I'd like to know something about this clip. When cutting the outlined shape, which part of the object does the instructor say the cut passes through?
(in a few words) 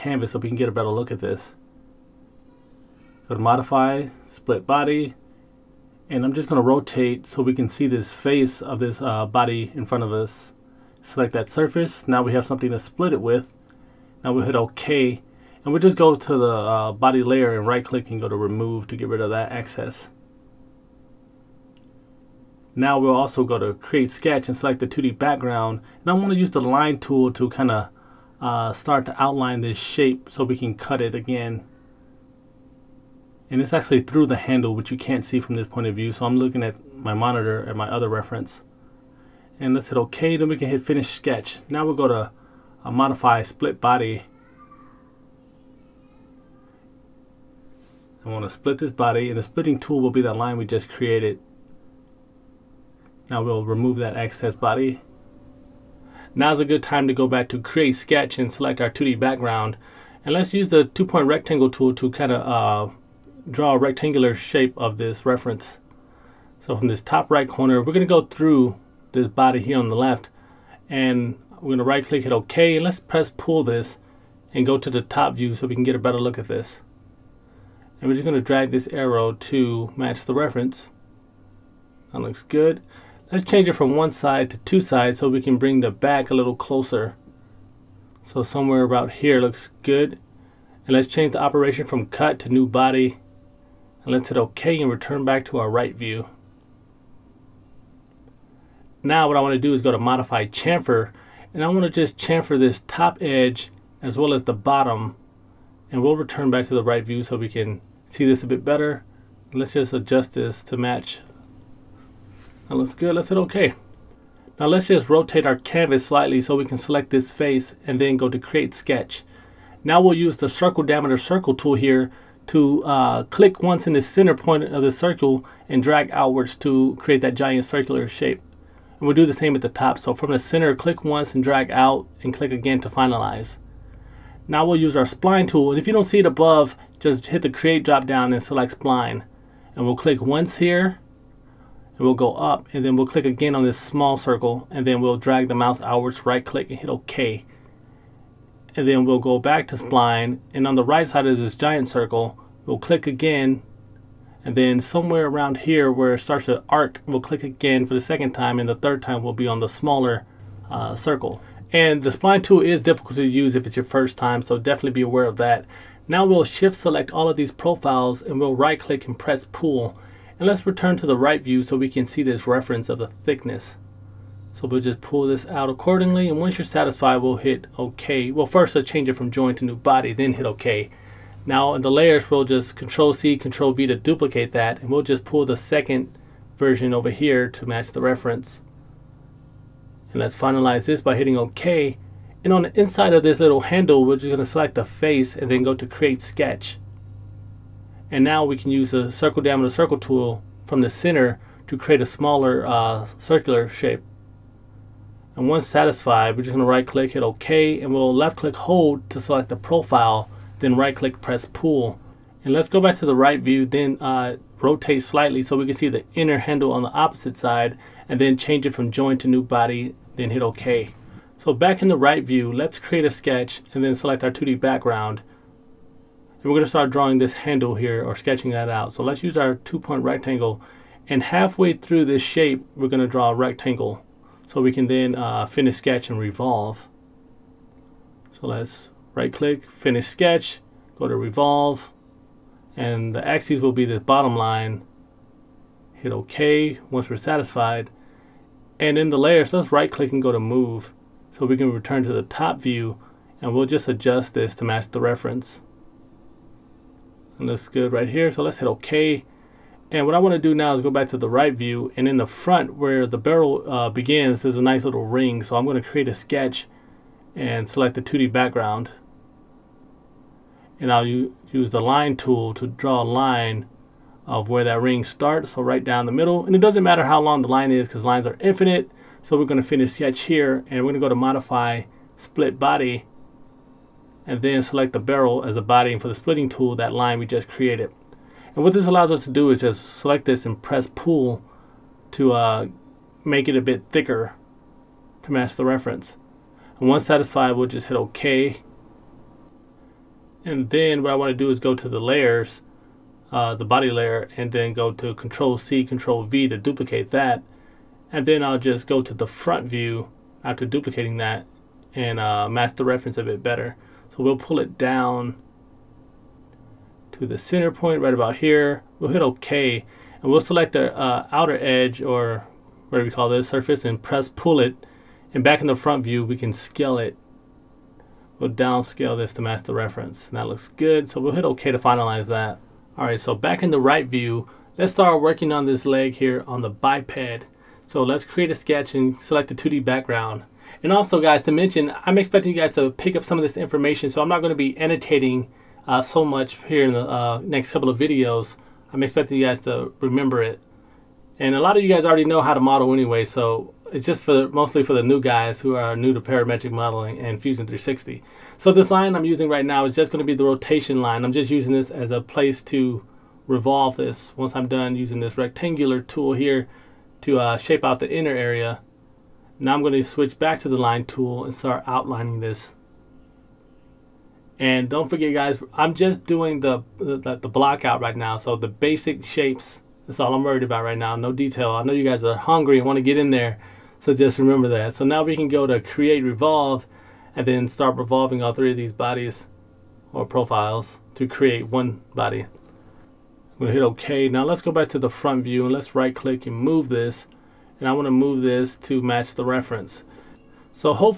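the handle.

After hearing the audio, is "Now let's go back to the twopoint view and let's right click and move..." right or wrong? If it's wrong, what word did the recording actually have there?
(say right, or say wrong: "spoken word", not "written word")
wrong: "front", not "twopoint".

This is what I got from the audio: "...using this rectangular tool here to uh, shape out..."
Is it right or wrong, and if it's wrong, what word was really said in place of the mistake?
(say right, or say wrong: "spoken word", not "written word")
right.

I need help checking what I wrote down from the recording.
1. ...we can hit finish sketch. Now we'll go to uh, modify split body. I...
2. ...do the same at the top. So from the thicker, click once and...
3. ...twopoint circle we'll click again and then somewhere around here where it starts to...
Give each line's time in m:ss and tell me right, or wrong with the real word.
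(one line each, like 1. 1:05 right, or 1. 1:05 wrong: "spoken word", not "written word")
1. 0:40 right
2. 2:09 wrong: "center", not "thicker"
3. 2:31 wrong: "giant", not "twopoint".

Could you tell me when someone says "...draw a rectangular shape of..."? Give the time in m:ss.
1:03.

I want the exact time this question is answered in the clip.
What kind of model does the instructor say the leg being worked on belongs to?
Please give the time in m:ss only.
5:36.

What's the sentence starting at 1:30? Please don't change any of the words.
And let's change the operation from cut to new body.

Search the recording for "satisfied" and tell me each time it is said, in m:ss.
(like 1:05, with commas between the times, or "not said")
2:56, 3:25, 4:07, 4:57.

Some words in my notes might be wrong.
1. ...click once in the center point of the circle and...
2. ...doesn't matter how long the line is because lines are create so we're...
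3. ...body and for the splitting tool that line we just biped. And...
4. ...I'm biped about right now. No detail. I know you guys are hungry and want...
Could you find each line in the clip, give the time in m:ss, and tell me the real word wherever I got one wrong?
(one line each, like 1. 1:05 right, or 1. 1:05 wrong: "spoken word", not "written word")
1. 2:03 right
2. 4:36 wrong: "infinite", not "create"
3. 4:45 wrong: "created", not "biped"
4. 6:20 wrong: "worried", not "biped".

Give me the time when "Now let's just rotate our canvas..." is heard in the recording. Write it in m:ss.
1:54.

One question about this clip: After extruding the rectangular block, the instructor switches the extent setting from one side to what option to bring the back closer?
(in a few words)
two sides.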